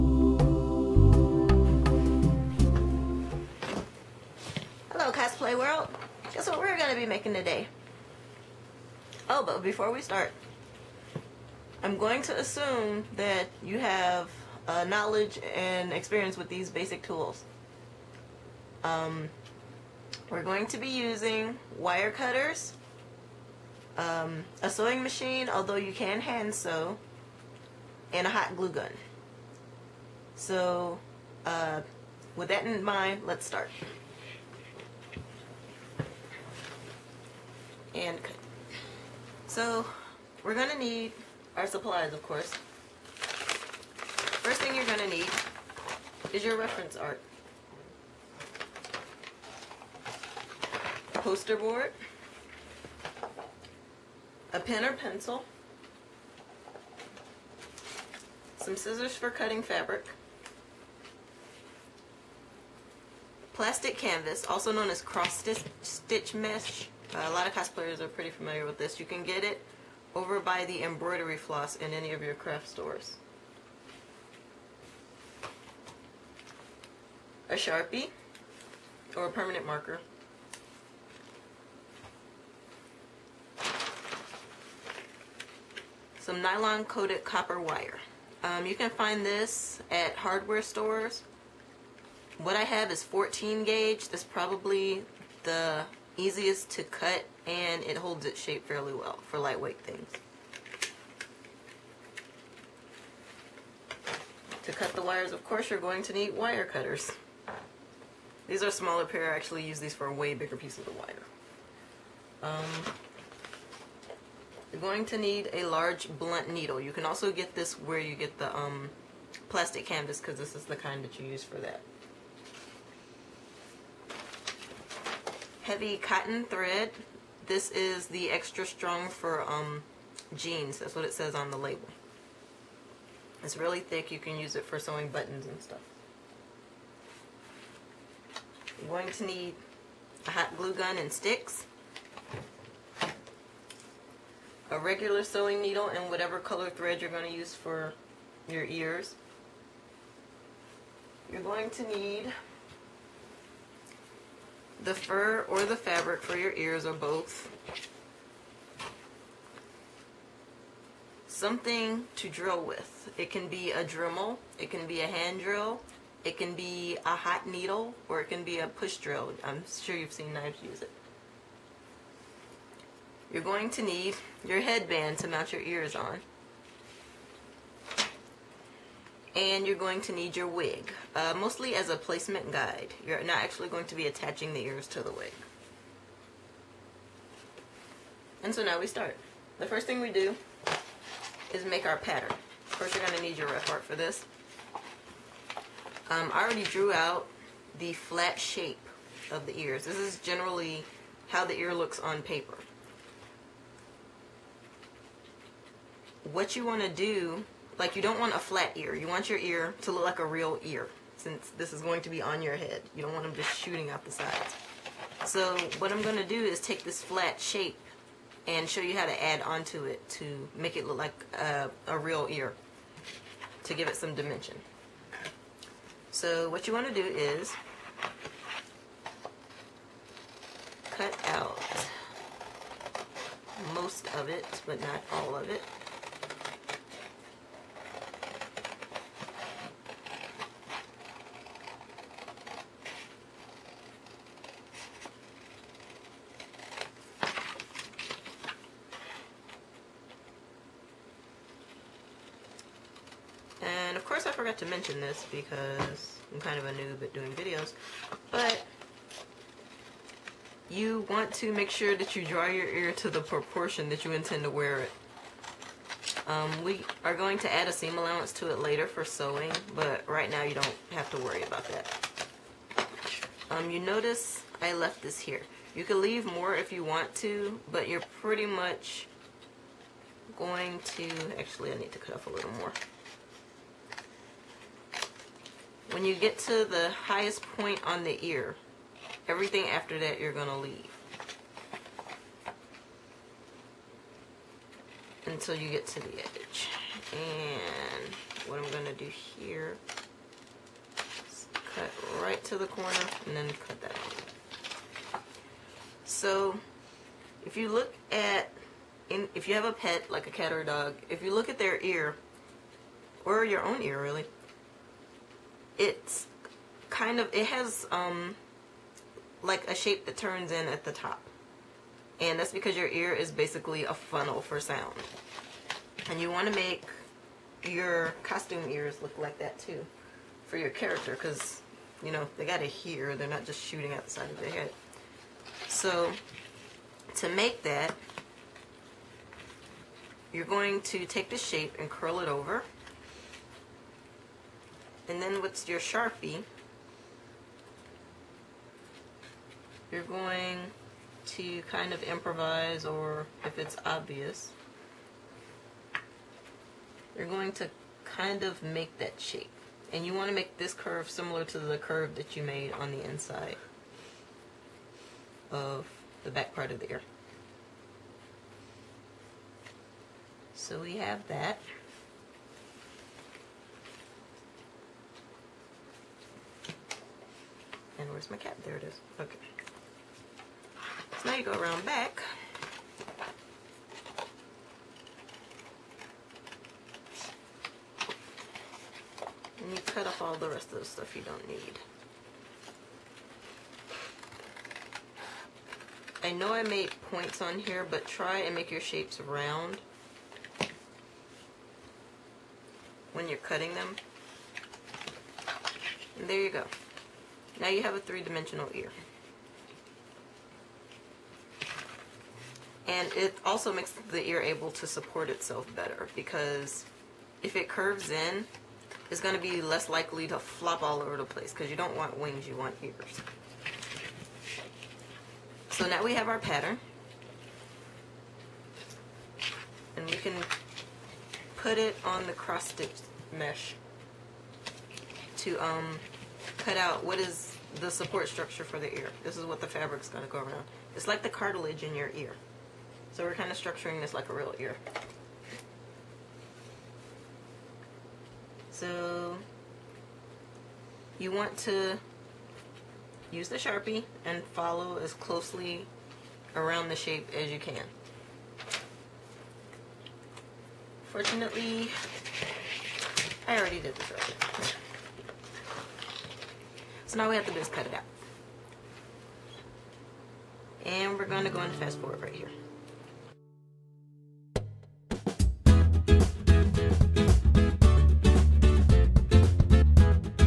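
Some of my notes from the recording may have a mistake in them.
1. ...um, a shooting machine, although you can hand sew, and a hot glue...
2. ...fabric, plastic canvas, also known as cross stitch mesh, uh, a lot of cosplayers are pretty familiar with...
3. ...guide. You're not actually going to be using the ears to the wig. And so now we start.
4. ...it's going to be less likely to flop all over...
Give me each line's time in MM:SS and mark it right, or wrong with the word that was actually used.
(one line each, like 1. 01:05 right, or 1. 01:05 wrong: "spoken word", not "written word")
1. 00:23 wrong: "sewing", not "shooting"
2. 00:59 right
3. 03:02 wrong: "attaching", not "using"
4. 06:59 right.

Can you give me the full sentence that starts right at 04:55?
Until you get to the edge.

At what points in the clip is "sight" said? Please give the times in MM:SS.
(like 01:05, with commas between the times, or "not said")
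not said.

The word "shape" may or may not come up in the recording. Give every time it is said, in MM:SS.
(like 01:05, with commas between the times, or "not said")
01:38, 03:18, 03:37, 05:19, 05:41, 05:59, 06:38, 07:36.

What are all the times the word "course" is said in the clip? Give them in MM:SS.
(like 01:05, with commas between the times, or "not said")
00:42, 01:45, 03:12.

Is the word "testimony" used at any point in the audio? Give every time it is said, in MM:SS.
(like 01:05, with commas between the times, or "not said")
not said.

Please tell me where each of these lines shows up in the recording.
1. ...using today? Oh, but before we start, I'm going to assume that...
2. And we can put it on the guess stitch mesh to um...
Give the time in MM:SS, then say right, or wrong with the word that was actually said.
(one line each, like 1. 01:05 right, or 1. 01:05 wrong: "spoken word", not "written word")
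1. 00:07 wrong: "making", not "using"
2. 07:09 wrong: "cross", not "guess".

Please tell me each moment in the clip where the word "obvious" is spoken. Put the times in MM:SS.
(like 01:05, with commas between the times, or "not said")
05:53.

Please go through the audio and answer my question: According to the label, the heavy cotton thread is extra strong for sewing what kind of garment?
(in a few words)
jeans.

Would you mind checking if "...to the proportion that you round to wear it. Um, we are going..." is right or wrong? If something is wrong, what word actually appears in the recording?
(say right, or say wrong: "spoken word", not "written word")
wrong: "intend", not "round".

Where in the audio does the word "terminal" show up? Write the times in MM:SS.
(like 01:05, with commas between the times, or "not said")
not said.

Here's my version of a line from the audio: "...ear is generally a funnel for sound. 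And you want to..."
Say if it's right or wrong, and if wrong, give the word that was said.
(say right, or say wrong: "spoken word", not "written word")
wrong: "basically", not "generally".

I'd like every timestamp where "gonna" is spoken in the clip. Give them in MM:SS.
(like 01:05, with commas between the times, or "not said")
00:40, 00:44.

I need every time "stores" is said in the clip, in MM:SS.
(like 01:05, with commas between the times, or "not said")
01:12, 01:30.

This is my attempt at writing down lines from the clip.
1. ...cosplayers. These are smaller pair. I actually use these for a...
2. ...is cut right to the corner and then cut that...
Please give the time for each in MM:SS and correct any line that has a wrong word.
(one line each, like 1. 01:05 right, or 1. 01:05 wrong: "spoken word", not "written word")
1. 01:46 wrong: "cutters", not "cosplayers"
2. 05:01 right.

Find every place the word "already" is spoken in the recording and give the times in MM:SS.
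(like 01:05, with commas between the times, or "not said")
03:16, 07:43.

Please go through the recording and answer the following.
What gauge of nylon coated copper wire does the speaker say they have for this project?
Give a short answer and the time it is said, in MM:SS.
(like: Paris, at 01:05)
14, at 01:33.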